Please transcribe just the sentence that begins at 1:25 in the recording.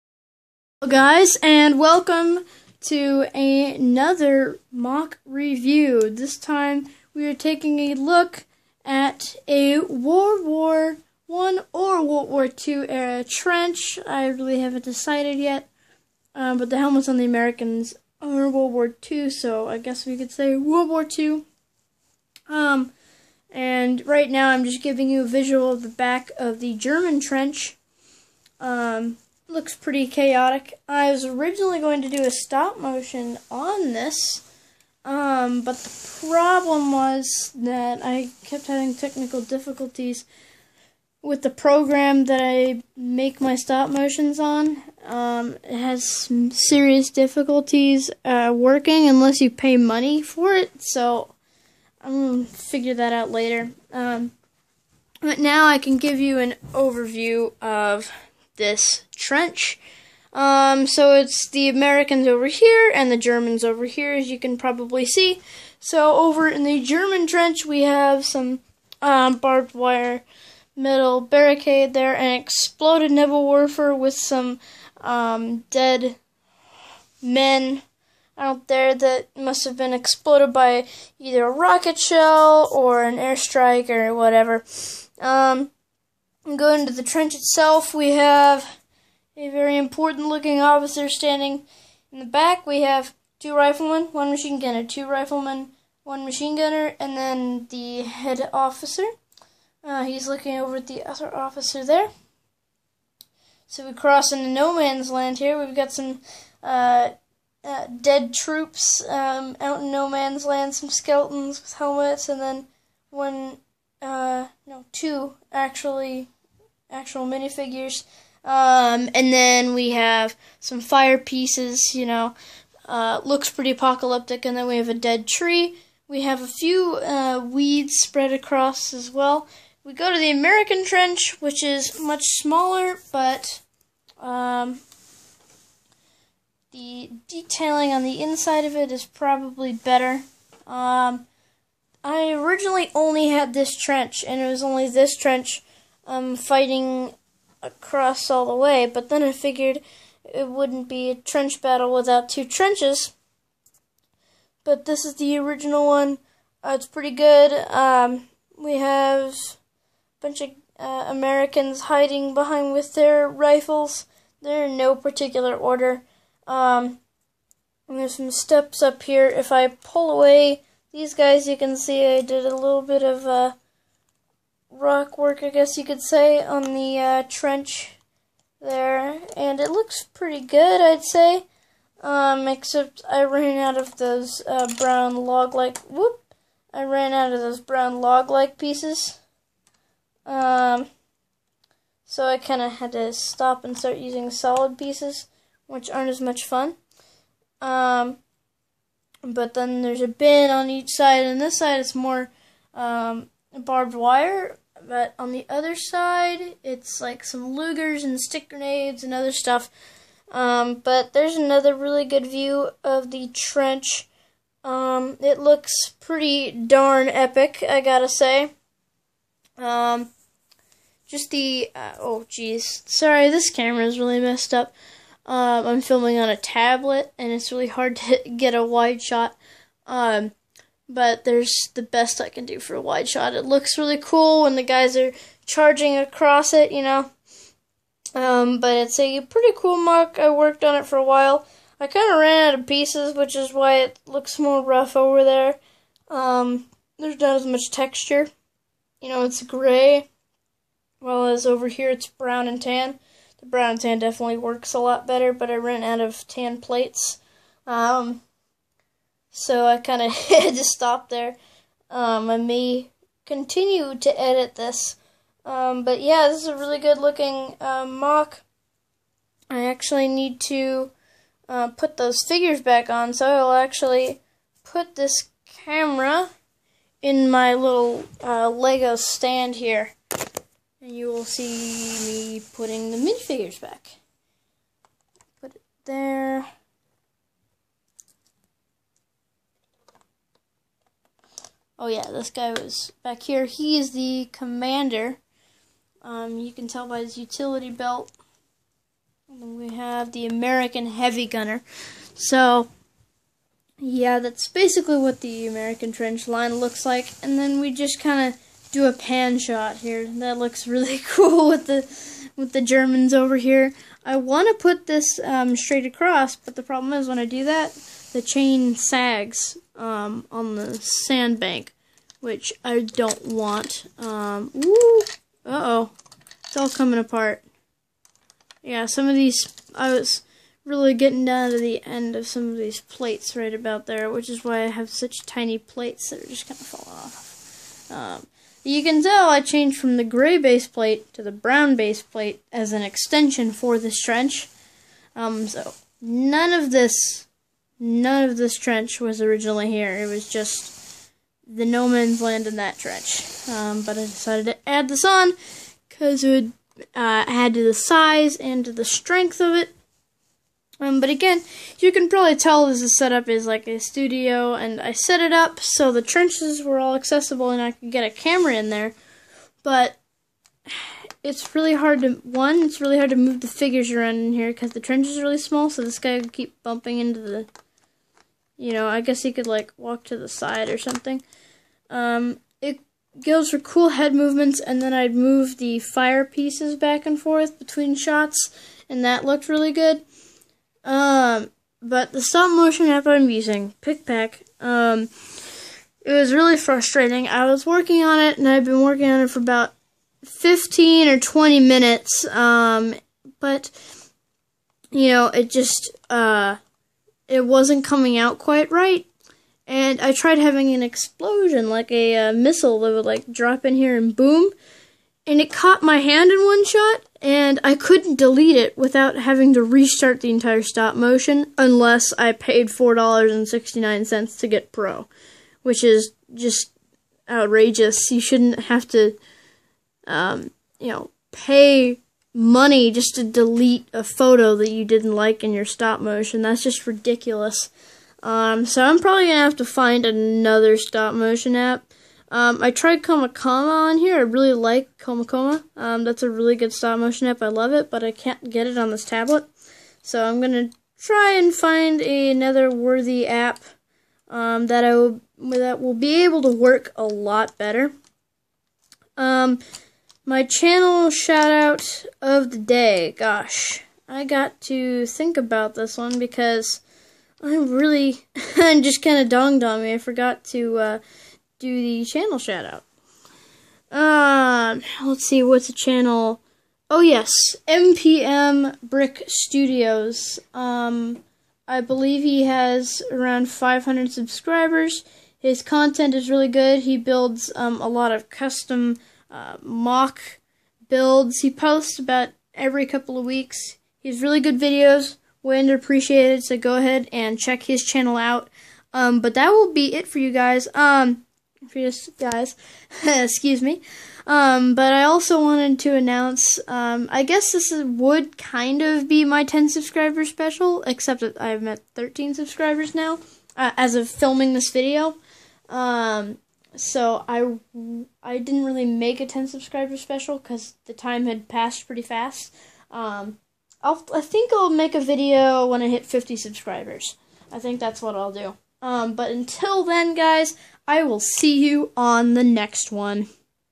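Um, go into the trench itself, we have a very important looking officer standing in the back.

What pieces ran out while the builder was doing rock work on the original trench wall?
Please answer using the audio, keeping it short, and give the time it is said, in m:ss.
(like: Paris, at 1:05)
brown log-like pieces, at 3:07.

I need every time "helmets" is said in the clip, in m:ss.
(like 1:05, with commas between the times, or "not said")
0:16, 1:51.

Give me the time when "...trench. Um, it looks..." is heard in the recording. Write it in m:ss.
3:33.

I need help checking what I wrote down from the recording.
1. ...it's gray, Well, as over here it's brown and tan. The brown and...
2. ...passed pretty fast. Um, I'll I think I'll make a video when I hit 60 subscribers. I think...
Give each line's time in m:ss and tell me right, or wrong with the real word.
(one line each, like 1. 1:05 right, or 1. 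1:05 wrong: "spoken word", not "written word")
1. 4:09 right
2. 8:41 wrong: "50", not "60".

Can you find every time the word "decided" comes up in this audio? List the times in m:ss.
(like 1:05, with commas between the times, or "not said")
0:14, 5:54.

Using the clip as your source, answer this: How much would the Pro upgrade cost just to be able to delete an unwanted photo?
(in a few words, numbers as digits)
$4.69.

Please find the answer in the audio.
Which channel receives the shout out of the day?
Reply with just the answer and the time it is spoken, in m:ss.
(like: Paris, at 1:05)
MPM Brick Studios, at 7:57.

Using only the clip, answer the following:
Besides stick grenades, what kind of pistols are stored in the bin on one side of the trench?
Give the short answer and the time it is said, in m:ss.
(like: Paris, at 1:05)
Lugers, at 3:27.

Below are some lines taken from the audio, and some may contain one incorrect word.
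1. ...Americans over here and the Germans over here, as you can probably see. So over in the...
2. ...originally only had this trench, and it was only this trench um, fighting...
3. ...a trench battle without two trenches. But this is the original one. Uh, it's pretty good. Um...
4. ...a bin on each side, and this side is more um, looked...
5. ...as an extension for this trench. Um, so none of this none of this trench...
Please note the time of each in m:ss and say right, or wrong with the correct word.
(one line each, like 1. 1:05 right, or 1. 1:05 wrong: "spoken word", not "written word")
1. 1:01 right
2. 2:22 right
3. 2:31 right
4. 3:20 wrong: "barbed", not "looked"
5. 5:42 right.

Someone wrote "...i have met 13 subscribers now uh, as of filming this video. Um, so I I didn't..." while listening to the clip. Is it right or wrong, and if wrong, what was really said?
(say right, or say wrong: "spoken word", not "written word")
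right.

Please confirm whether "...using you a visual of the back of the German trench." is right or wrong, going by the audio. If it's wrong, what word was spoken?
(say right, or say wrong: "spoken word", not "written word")
wrong: "giving", not "using".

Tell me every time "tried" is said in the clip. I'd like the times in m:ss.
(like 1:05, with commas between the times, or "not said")
6:50, 7:22.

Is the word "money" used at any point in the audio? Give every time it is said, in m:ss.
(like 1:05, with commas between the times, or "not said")
0:49, 7:12.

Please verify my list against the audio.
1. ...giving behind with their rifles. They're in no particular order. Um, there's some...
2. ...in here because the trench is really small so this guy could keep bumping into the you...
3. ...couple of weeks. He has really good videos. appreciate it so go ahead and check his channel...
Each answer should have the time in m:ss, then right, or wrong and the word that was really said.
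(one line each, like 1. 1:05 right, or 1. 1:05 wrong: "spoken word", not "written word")
1. 2:41 wrong: "hiding", not "giving"
2. 6:14 right
3. 8:12 right.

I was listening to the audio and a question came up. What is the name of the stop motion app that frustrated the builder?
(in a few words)
PicPac.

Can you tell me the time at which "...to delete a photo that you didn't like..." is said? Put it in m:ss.
7:13.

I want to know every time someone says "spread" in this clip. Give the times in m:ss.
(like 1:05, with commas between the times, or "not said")
2:07.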